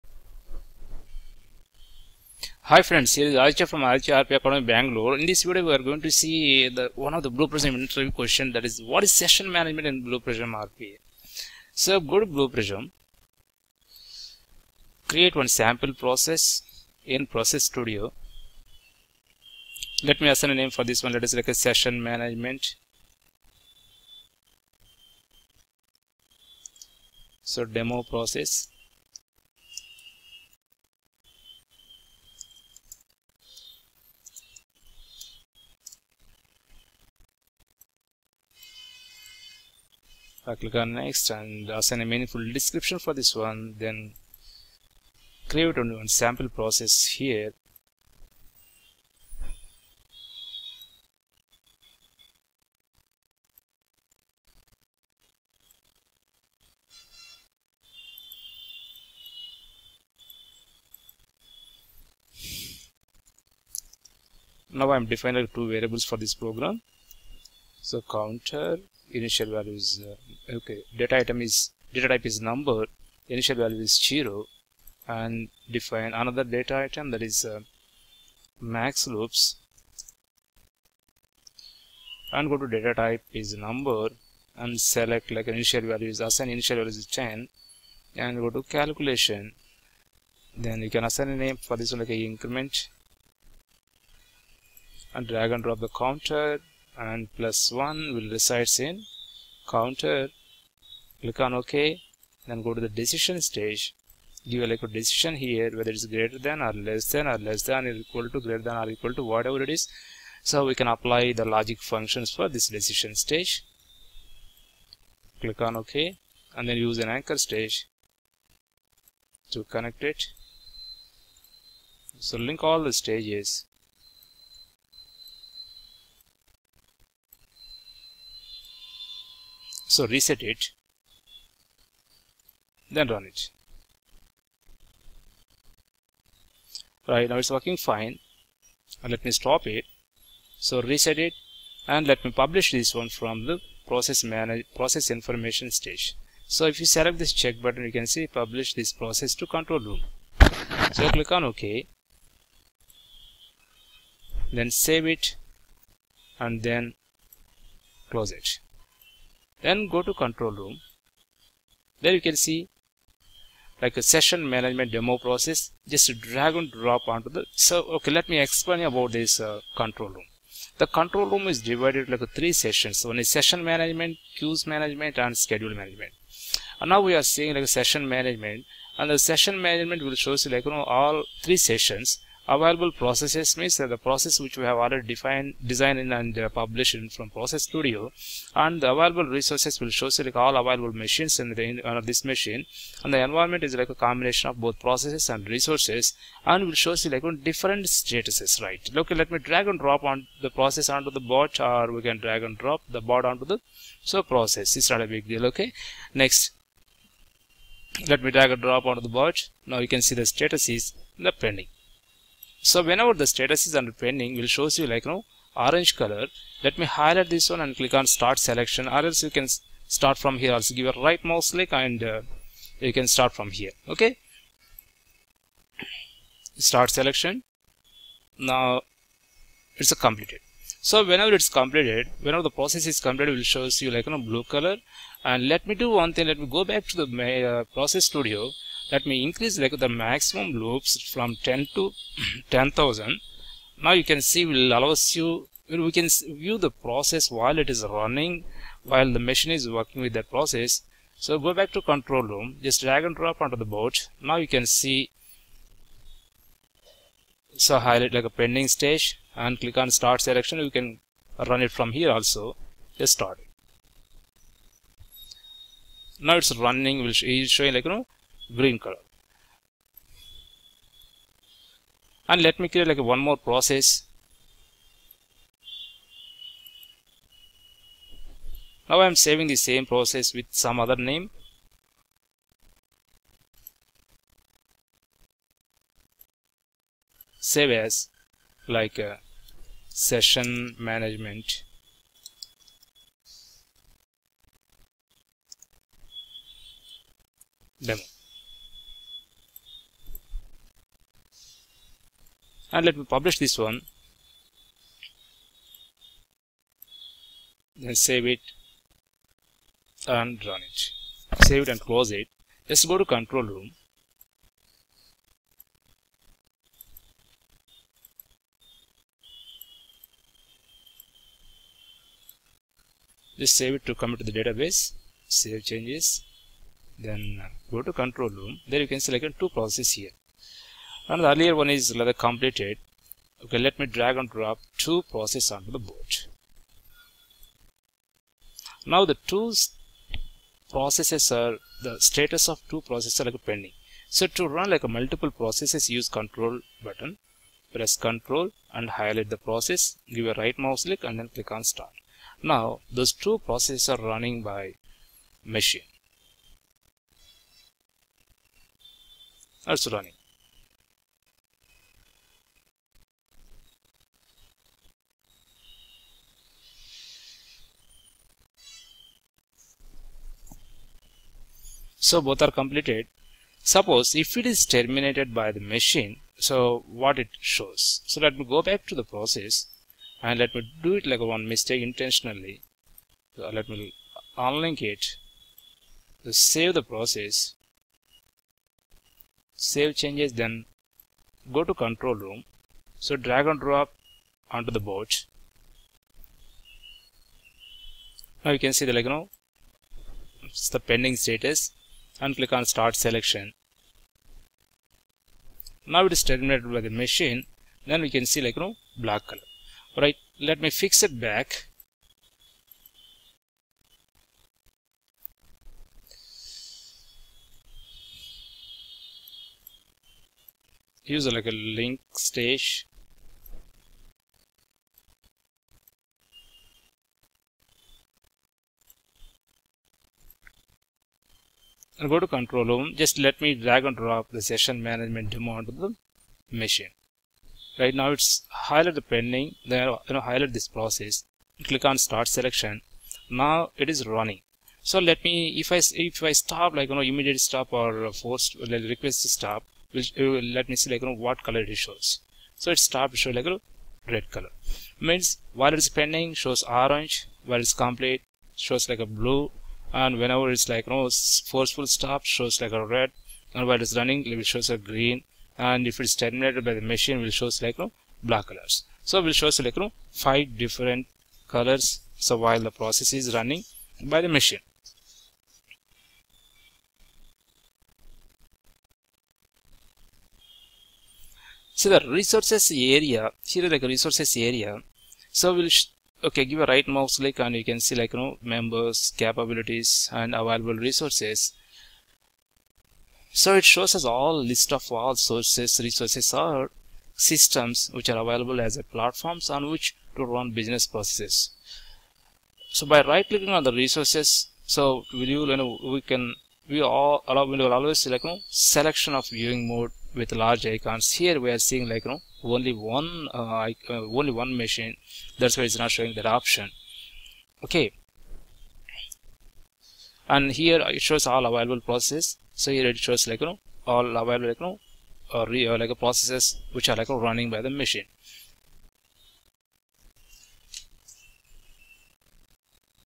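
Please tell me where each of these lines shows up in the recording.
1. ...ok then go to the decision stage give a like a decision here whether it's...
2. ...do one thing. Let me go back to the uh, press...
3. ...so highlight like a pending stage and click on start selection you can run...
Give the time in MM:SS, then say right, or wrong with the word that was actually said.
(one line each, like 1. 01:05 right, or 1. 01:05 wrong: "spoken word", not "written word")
1. 01:41 right
2. 03:55 wrong: "process", not "press"
3. 04:17 right.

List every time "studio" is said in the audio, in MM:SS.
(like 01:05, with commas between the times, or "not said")
00:17, 03:07, 03:58.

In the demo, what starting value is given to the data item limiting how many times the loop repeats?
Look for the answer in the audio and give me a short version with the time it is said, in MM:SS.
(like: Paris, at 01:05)
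10, at 01:26.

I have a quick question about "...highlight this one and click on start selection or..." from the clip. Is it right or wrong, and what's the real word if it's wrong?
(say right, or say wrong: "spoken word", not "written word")
right.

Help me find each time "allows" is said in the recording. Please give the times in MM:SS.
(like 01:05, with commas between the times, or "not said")
04:04, 08:27.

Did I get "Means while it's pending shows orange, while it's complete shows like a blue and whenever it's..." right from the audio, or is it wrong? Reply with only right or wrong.
right.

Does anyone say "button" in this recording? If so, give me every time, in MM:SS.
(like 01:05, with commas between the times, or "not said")
02:27, 05:46.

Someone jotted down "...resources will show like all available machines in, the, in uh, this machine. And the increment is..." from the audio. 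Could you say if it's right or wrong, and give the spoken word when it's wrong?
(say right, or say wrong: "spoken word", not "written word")
wrong: "environment", not "increment".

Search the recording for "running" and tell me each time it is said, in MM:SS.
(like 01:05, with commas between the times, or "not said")
04:07, 04:26, 05:54, 05:59, 07:24, 07:43, 07:53, 08:47.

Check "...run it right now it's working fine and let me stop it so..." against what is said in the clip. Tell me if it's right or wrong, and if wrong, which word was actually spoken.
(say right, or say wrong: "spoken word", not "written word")
right.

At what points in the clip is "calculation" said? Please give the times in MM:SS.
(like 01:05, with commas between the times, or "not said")
01:28.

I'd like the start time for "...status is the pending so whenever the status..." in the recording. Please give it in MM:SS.
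03:30.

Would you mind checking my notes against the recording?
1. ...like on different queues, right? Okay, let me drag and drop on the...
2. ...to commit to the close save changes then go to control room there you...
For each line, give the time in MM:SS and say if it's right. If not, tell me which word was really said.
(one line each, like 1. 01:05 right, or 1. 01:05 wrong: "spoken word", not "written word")
1. 03:17 wrong: "statuses", not "queues"
2. 05:23 wrong: "database", not "close".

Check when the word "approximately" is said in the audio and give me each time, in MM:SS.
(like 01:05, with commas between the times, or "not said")
not said.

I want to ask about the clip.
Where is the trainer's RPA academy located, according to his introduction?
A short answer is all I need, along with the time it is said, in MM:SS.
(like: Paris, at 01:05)
Bangalore, at 00:04.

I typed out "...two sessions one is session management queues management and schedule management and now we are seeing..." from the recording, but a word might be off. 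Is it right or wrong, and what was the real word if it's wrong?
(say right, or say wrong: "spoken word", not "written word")
wrong: "three", not "two".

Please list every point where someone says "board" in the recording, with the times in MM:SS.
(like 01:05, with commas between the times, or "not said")
04:13, 05:35, 06:34.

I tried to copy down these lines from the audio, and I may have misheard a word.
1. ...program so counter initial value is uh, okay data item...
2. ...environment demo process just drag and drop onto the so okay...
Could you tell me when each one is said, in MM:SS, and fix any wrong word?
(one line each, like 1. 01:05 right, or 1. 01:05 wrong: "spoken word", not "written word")
1. 01:06 right
2. 02:44 wrong: "management", not "environment".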